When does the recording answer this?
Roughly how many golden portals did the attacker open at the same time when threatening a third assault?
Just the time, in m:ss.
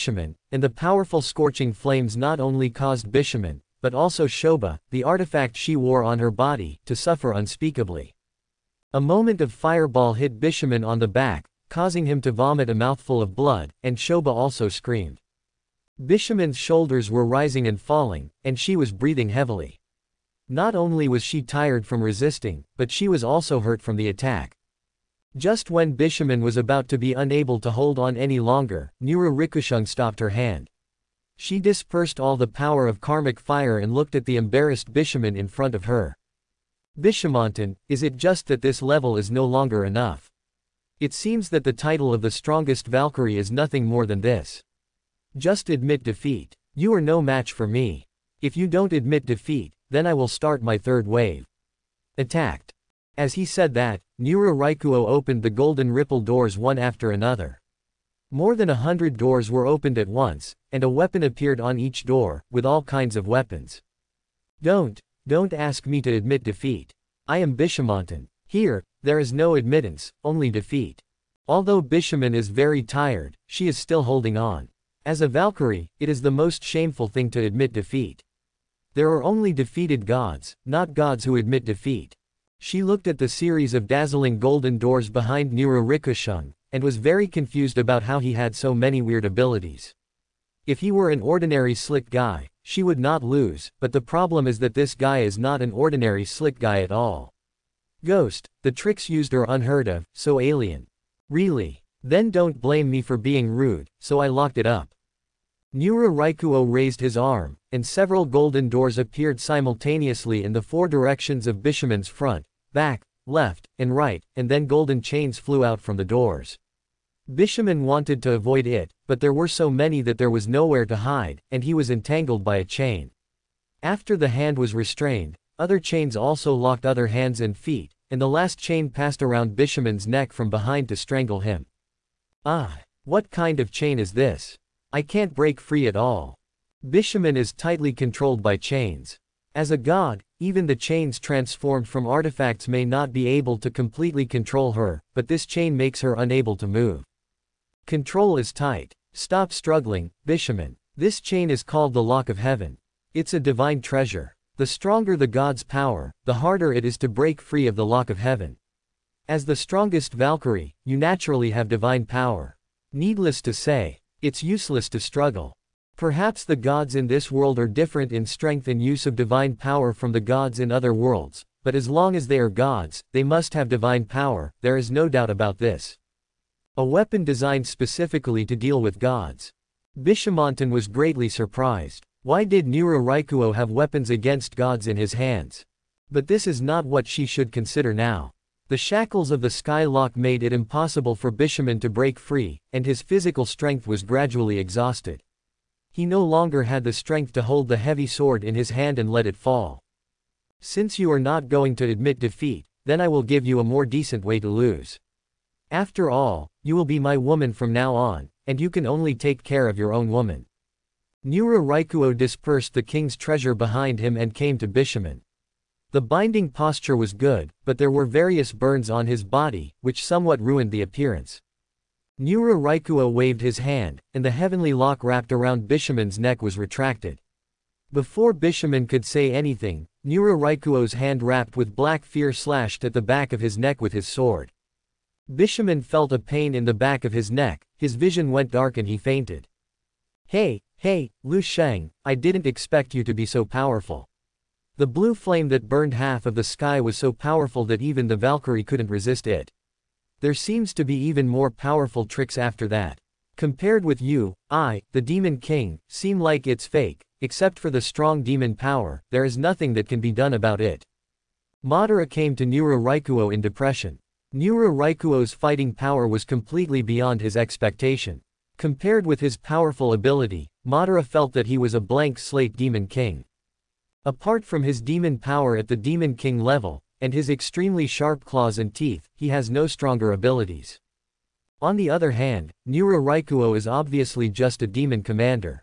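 0:58.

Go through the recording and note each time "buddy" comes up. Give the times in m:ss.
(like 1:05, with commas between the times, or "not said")
not said.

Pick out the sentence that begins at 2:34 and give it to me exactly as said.
The stronger the god's power, the harder it is to break free of the lock of heaven.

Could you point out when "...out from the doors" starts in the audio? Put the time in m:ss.
1:55.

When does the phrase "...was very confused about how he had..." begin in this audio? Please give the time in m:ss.
1:26.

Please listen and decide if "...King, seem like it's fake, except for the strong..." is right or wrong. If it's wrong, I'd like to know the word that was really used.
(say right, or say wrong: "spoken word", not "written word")
right.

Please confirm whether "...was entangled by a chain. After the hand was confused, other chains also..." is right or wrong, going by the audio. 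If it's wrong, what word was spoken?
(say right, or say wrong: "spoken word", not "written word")
wrong: "restrained", not "confused".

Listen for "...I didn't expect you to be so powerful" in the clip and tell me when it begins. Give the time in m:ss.
4:02.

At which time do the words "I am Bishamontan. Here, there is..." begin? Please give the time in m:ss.
1:07.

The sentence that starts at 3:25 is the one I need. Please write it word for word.
After all, you will be my woman from now on, and you can only take care of your own woman.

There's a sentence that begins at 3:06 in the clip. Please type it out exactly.
But this is not what she should consider now.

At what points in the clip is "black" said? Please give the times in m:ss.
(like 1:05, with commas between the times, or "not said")
3:51.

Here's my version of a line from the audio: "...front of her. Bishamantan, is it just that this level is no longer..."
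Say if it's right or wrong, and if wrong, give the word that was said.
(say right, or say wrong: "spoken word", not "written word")
right.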